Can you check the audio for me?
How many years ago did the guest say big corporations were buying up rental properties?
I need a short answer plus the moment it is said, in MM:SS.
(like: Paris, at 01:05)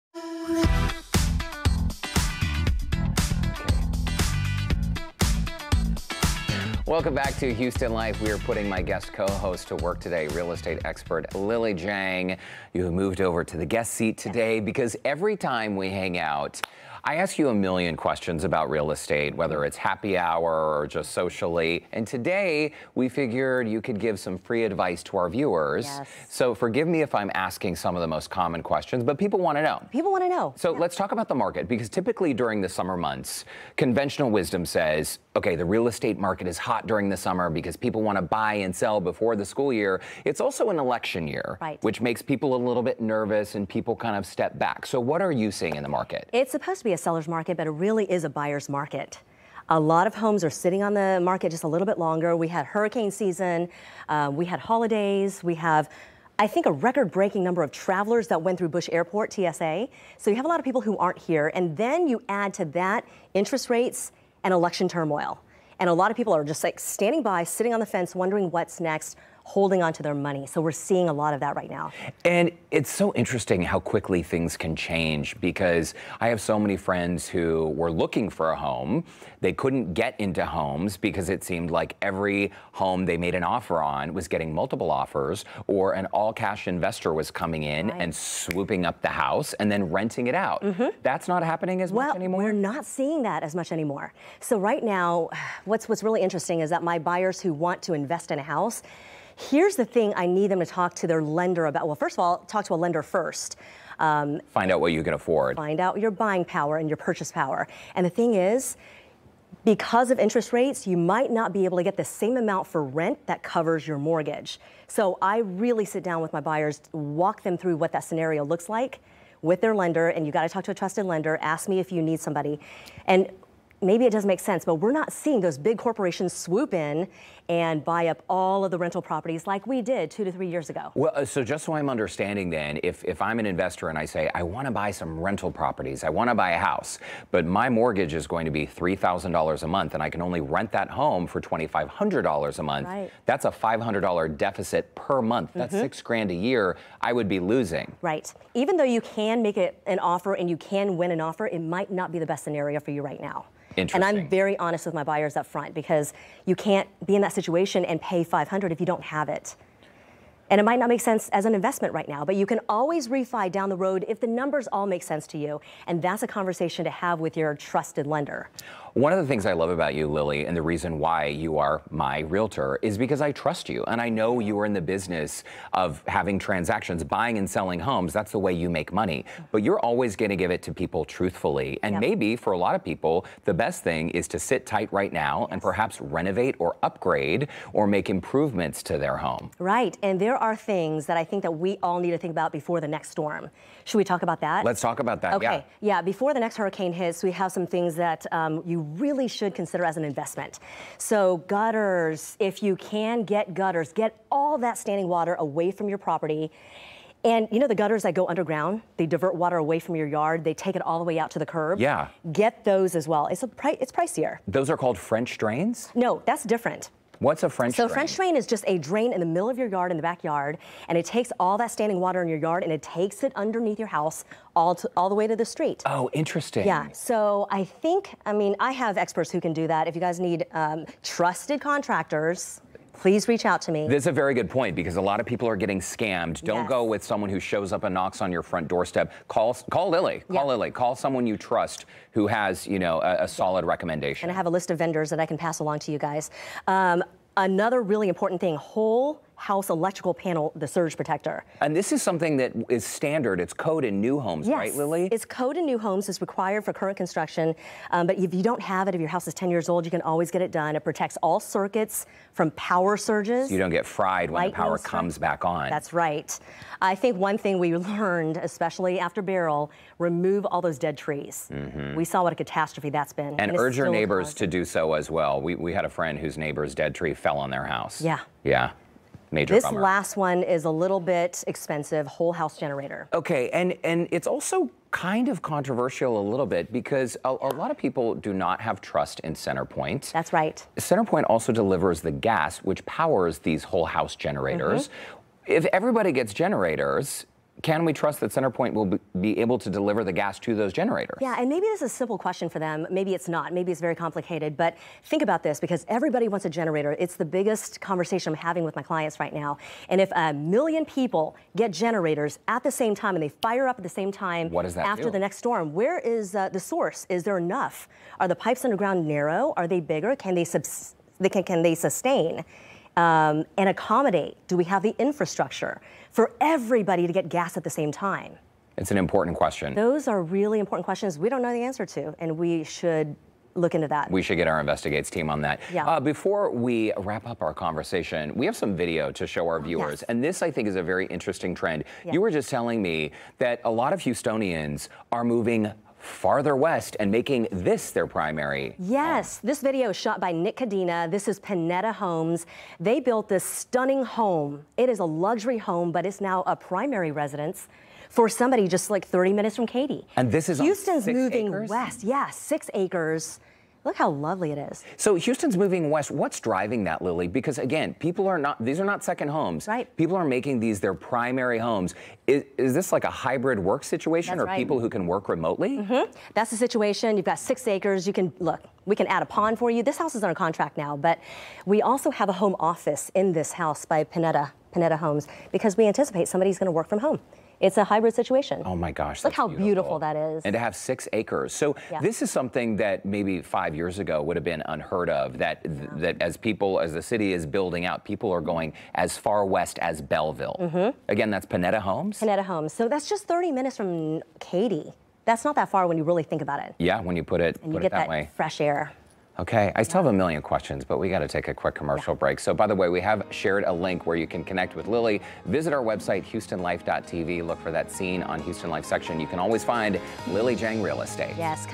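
2 to 3 years, at 02:10.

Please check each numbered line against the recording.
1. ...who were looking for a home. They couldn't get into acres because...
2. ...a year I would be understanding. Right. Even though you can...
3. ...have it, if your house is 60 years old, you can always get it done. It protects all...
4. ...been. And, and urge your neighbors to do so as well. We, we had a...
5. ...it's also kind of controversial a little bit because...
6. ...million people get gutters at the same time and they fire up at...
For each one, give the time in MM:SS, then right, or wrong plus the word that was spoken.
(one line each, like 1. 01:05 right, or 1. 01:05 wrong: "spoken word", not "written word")
1. 01:17 wrong: "homes", not "acres"
2. 02:26 wrong: "losing", not "understanding"
3. 04:18 wrong: "10", not "60"
4. 04:33 right
5. 04:44 right
6. 05:10 wrong: "generators", not "gutters".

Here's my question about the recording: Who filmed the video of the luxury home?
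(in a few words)
Nick Cadena.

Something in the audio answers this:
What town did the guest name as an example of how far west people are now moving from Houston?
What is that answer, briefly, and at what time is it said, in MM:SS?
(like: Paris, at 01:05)
Bellville, at 06:40.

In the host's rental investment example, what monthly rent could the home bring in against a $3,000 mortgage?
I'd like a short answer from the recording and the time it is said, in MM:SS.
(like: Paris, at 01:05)
$2,500, at 02:21.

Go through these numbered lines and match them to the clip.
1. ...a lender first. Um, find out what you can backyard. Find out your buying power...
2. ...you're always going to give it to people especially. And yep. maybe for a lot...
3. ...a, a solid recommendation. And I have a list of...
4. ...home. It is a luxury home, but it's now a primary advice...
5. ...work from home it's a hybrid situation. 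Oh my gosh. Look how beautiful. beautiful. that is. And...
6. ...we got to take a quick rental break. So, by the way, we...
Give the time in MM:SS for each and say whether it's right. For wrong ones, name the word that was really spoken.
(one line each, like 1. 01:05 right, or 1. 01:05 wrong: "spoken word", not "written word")
1. 01:42 wrong: "afford", not "backyard"
2. 02:59 wrong: "truthfully", not "especially"
3. 04:03 right
4. 05:54 wrong: "residence", not "advice"
5. 06:26 right
6. 06:50 wrong: "commercial", not "rental".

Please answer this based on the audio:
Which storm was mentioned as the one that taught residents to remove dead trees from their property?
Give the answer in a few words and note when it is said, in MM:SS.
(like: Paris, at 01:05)
Beryl, at 04:29.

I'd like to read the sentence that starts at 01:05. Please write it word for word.
And a lot of people are just like standing by, sitting on the fence, wondering what's next holding on to their money.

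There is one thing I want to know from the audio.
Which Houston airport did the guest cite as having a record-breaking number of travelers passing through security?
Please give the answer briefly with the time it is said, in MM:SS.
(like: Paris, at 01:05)
Bush Airport, at 00:58.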